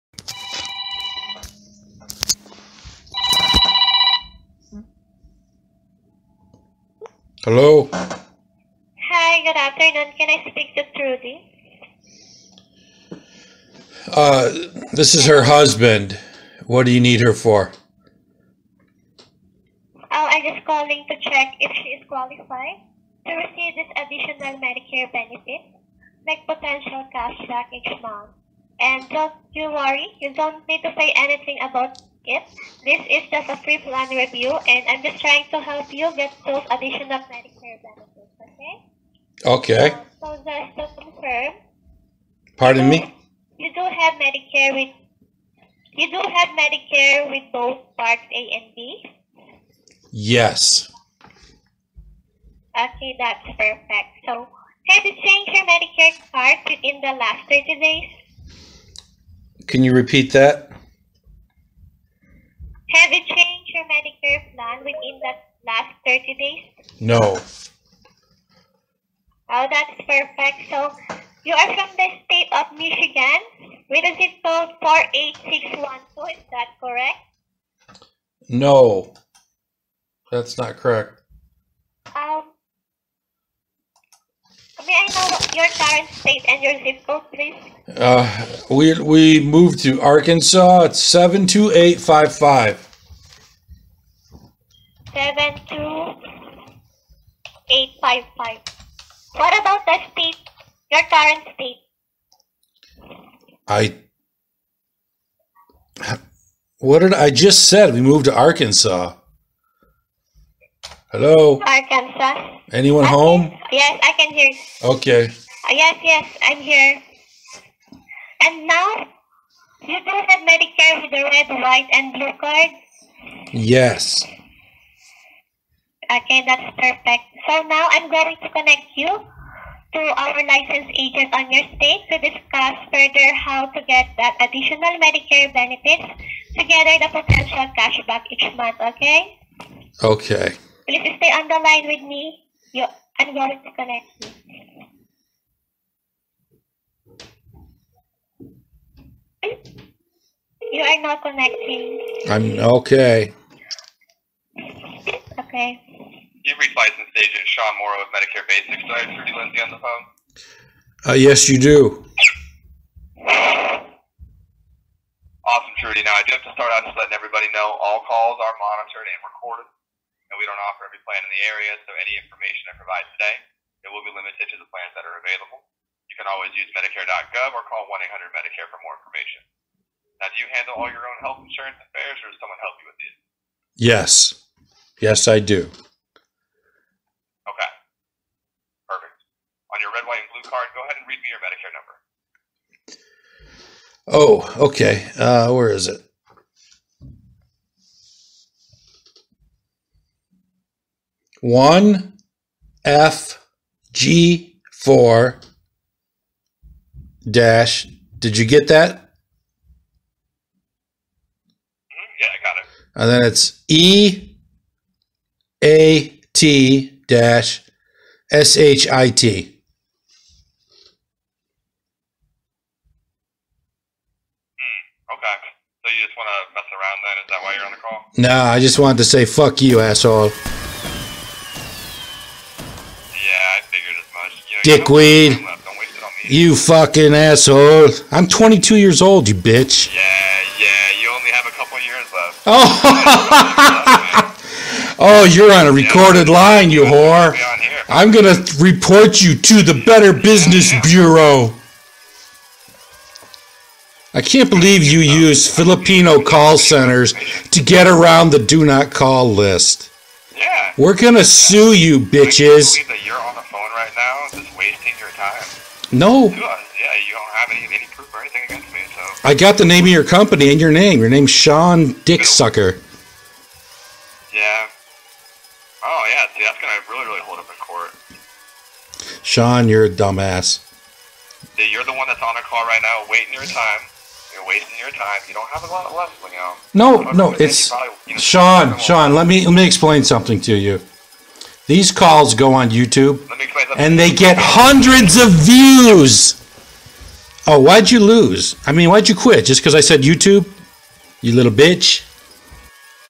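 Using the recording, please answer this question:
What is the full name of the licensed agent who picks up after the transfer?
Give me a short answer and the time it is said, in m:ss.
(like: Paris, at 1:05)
Sean Morrow, at 2:37.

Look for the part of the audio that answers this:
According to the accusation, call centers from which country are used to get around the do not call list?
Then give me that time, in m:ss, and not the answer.
4:15.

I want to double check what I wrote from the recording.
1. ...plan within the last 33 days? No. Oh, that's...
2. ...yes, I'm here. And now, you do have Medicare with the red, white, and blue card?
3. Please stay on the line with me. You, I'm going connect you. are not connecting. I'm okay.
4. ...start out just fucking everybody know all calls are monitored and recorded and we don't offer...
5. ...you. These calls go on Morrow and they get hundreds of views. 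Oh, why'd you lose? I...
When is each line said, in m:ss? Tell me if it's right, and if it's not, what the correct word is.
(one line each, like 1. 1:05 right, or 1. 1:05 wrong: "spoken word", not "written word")
1. 1:04 wrong: "30", not "33"
2. 1:56 right
3. 2:20 right
4. 2:46 wrong: "letting", not "fucking"
5. 4:50 wrong: "YouTube", not "Morrow".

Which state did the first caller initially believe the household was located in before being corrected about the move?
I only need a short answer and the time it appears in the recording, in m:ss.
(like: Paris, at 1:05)
Michigan, at 1:12.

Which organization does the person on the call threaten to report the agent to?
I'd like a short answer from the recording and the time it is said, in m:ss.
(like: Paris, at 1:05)
Better Business Bureau, at 4:09.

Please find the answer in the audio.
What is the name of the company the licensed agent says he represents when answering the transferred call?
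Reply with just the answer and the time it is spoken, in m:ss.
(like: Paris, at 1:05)
Medicare Basics, at 2:38.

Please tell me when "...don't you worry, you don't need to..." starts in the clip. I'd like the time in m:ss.
0:29.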